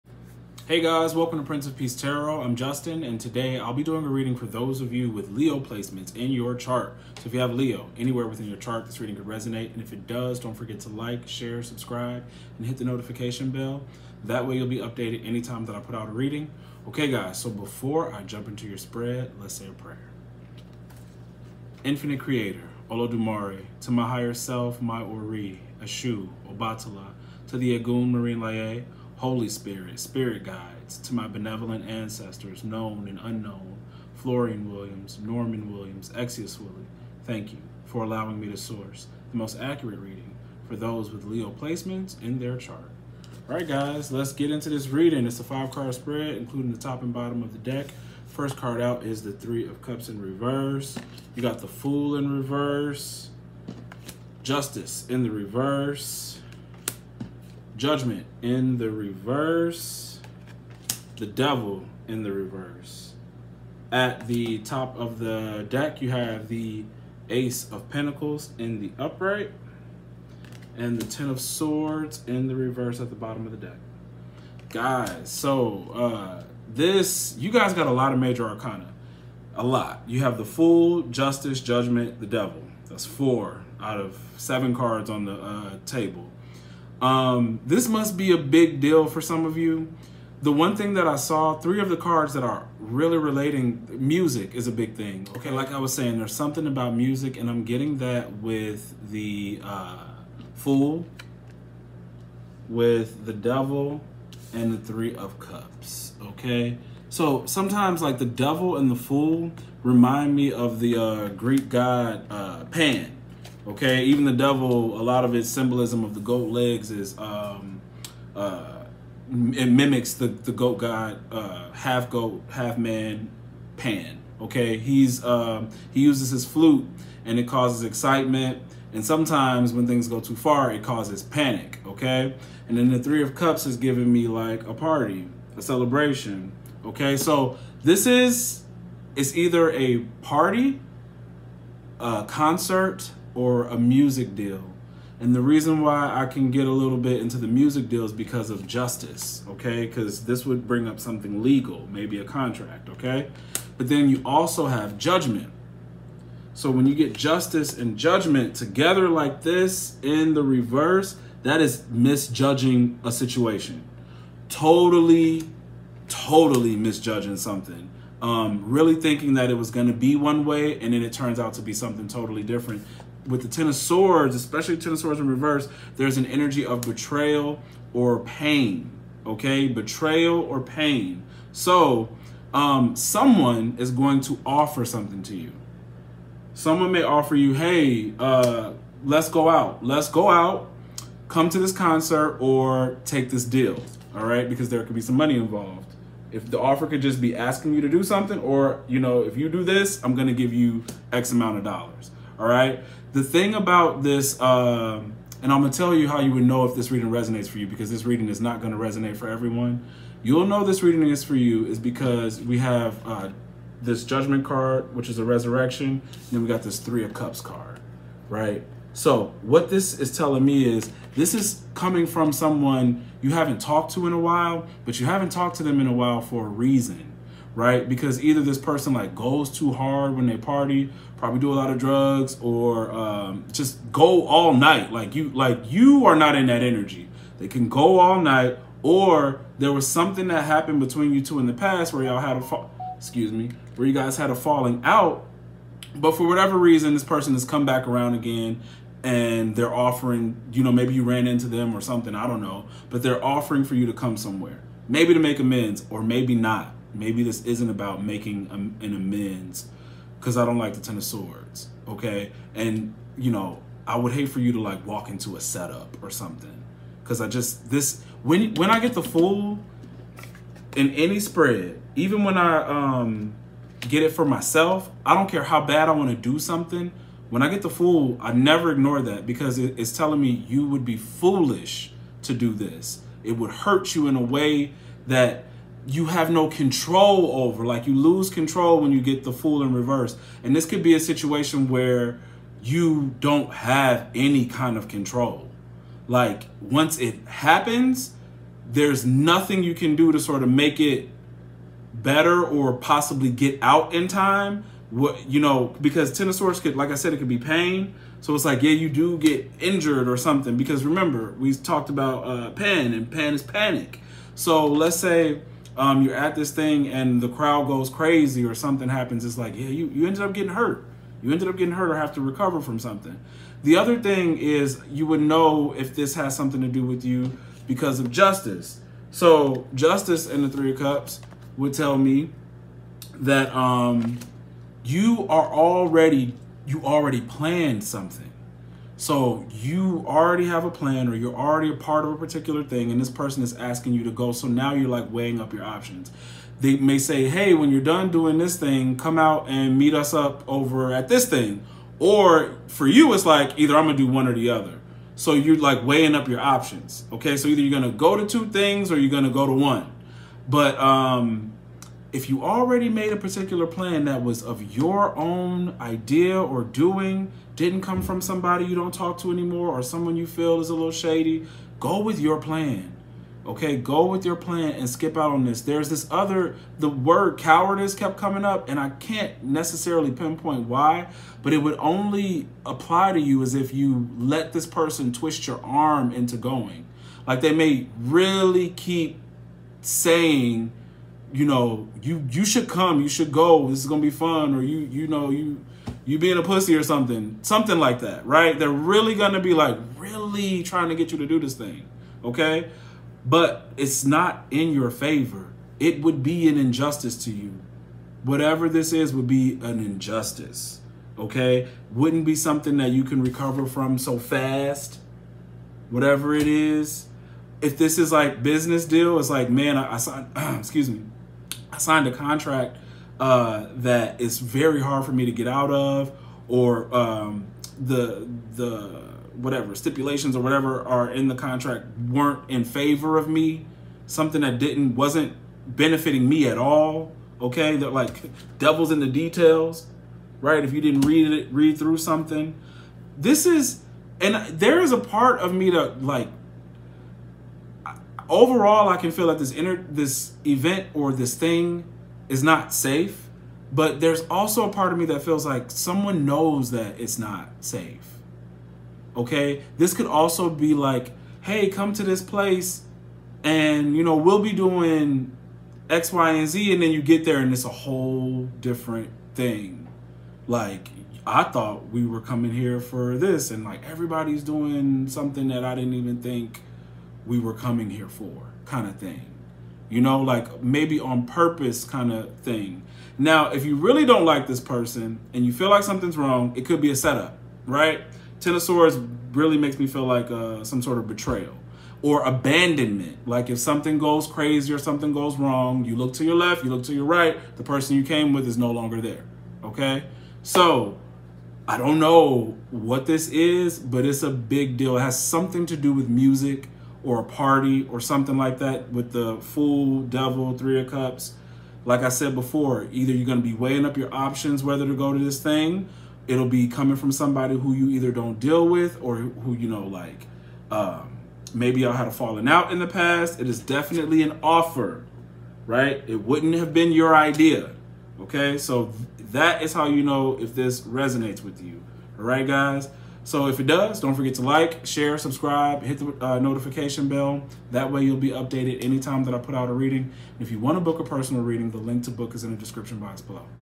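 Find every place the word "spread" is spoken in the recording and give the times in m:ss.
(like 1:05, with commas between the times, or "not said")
0:18, 0:45, 4:31.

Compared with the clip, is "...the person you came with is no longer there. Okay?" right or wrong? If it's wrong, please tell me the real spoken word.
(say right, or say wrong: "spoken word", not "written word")
right.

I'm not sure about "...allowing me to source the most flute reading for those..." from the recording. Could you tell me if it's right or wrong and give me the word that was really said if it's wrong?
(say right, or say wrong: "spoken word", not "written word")
wrong: "accurate", not "flute".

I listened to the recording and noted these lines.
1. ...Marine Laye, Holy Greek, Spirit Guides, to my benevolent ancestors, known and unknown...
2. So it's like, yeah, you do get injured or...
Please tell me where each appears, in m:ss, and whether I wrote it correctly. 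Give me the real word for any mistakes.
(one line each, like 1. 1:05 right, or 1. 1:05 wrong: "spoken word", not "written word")
1. 0:28 wrong: "Spirit", not "Greek"
2. 5:08 right.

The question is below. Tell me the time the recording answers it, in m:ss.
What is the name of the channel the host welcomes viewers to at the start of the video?
0:01.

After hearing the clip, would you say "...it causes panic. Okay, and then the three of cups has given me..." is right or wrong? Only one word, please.
right.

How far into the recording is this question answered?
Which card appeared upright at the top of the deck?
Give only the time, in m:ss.
1:07.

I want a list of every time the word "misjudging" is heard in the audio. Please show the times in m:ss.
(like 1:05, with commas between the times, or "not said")
2:41, 2:46.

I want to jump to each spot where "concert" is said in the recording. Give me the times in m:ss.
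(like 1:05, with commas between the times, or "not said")
2:22, 3:11.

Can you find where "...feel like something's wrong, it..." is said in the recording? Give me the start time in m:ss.
8:05.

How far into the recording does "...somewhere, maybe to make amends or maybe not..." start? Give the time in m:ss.
4:14.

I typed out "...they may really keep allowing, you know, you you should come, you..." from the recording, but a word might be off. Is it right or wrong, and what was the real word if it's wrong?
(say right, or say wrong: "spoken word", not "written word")
wrong: "saying", not "allowing".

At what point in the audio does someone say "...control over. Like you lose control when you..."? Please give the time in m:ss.
4:46.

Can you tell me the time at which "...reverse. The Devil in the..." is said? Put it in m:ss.
0:58.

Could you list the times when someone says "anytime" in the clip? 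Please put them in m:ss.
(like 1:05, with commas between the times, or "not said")
0:15, 8:58.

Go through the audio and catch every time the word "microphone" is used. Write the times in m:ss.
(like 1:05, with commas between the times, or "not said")
not said.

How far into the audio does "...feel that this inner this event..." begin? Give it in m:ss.
7:29.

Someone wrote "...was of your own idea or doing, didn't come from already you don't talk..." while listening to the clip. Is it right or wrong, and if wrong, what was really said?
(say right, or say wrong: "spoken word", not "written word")
wrong: "somebody", not "already".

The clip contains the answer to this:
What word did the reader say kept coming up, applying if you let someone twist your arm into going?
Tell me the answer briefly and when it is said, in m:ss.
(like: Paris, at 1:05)
cowardice, at 6:17.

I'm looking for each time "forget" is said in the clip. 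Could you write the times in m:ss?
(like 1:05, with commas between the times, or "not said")
0:10, 8:54.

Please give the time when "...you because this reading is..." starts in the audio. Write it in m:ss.
3:27.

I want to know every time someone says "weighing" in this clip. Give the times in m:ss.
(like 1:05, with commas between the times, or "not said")
5:45, 5:55, 8:33.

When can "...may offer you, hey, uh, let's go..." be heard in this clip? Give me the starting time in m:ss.
3:06.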